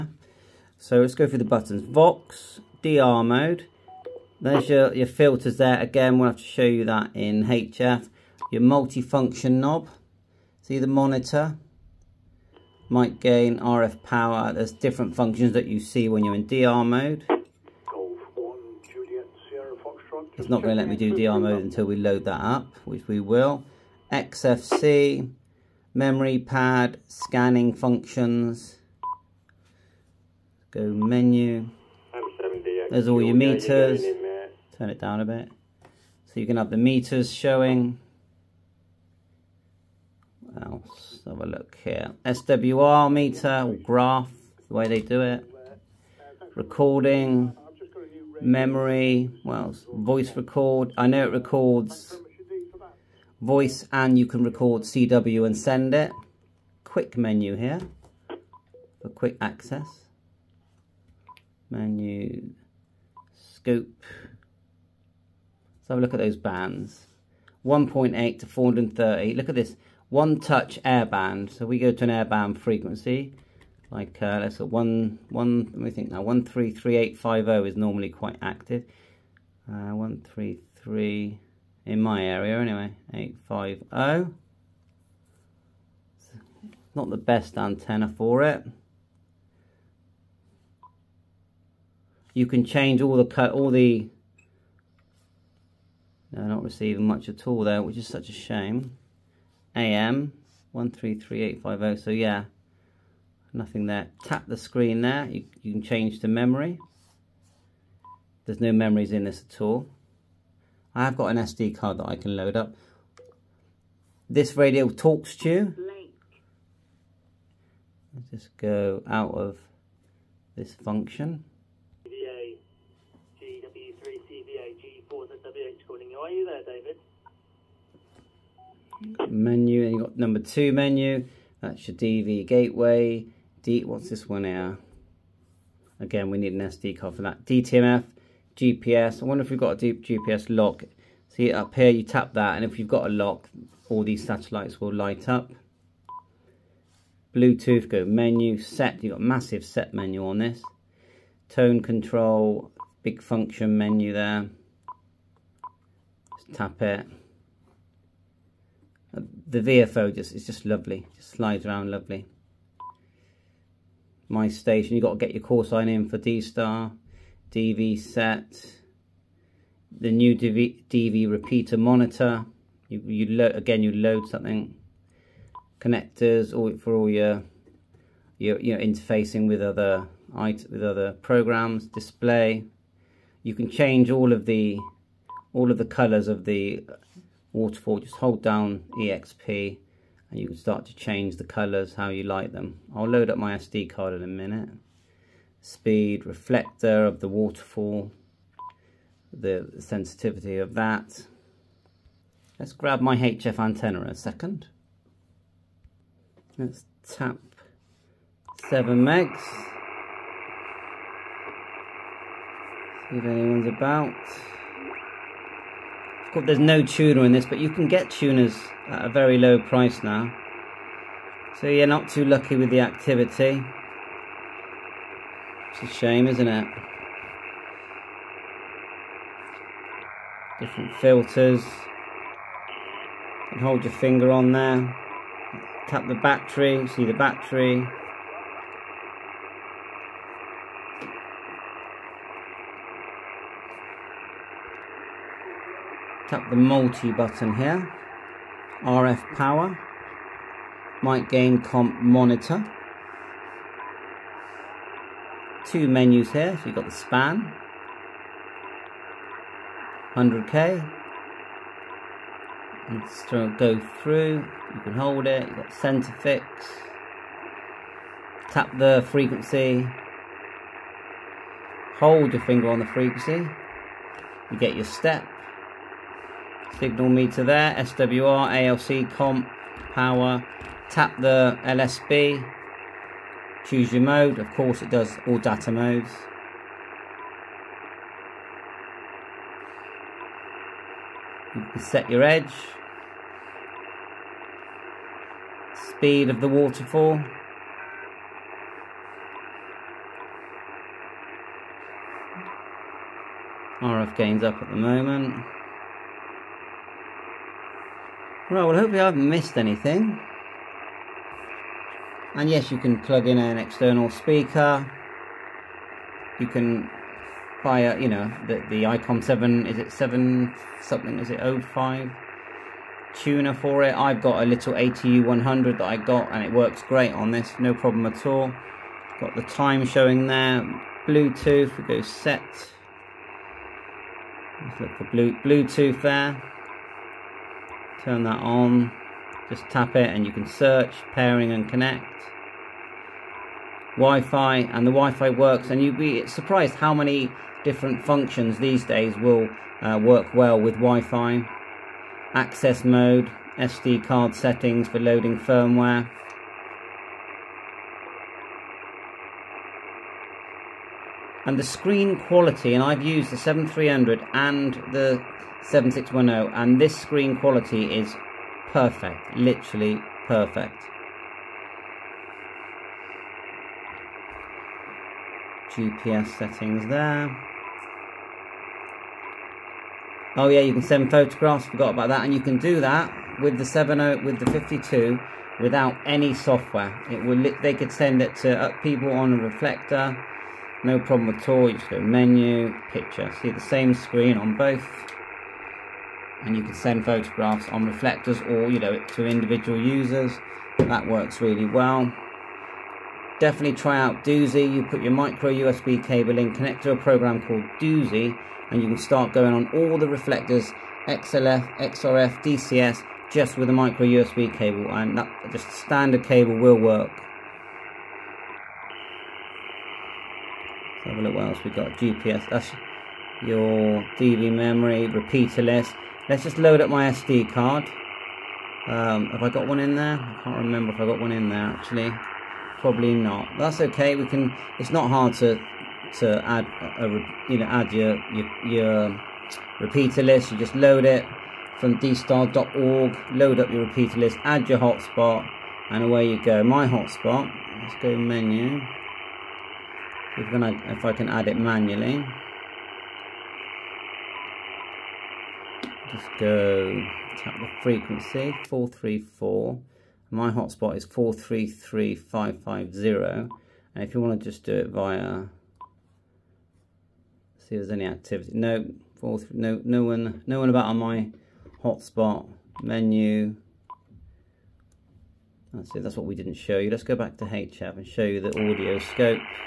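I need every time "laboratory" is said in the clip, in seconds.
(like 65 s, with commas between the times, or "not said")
not said.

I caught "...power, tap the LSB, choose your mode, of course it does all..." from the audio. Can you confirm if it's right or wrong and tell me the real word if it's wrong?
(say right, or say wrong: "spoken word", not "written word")
right.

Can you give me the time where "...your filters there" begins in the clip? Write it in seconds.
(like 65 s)
4 s.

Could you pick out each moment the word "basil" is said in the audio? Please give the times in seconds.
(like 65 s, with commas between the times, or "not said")
not said.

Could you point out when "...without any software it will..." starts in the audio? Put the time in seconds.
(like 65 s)
385 s.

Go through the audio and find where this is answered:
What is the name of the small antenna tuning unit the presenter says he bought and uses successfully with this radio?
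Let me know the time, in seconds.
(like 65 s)
324 s.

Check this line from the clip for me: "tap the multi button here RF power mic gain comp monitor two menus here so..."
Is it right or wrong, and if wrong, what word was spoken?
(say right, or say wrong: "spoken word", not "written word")
right.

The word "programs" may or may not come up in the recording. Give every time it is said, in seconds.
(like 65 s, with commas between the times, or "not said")
181 s, 406 s.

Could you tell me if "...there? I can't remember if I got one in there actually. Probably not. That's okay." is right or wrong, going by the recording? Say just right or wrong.
right.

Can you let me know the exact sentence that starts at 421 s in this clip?
GPS, that's your DV memory, repeater list.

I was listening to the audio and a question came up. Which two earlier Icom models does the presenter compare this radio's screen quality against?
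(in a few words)
7300 and 7610.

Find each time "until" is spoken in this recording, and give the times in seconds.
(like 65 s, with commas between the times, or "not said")
21 s.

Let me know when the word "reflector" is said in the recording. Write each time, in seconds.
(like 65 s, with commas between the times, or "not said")
196 s, 389 s, 397 s, 410 s.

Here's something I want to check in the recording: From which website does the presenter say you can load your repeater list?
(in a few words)
dstar.org.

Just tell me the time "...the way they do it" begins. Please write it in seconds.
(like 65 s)
44 s.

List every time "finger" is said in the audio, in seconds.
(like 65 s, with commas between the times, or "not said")
233 s, 272 s.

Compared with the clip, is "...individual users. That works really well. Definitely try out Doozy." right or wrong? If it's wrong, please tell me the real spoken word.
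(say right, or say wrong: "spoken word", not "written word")
right.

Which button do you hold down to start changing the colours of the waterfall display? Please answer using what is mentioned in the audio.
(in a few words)
EXP.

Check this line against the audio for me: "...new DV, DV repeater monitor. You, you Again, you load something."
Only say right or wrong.
right.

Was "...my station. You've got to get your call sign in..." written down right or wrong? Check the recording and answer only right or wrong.
right.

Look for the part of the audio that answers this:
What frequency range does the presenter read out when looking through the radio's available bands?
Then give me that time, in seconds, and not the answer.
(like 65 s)
67 s.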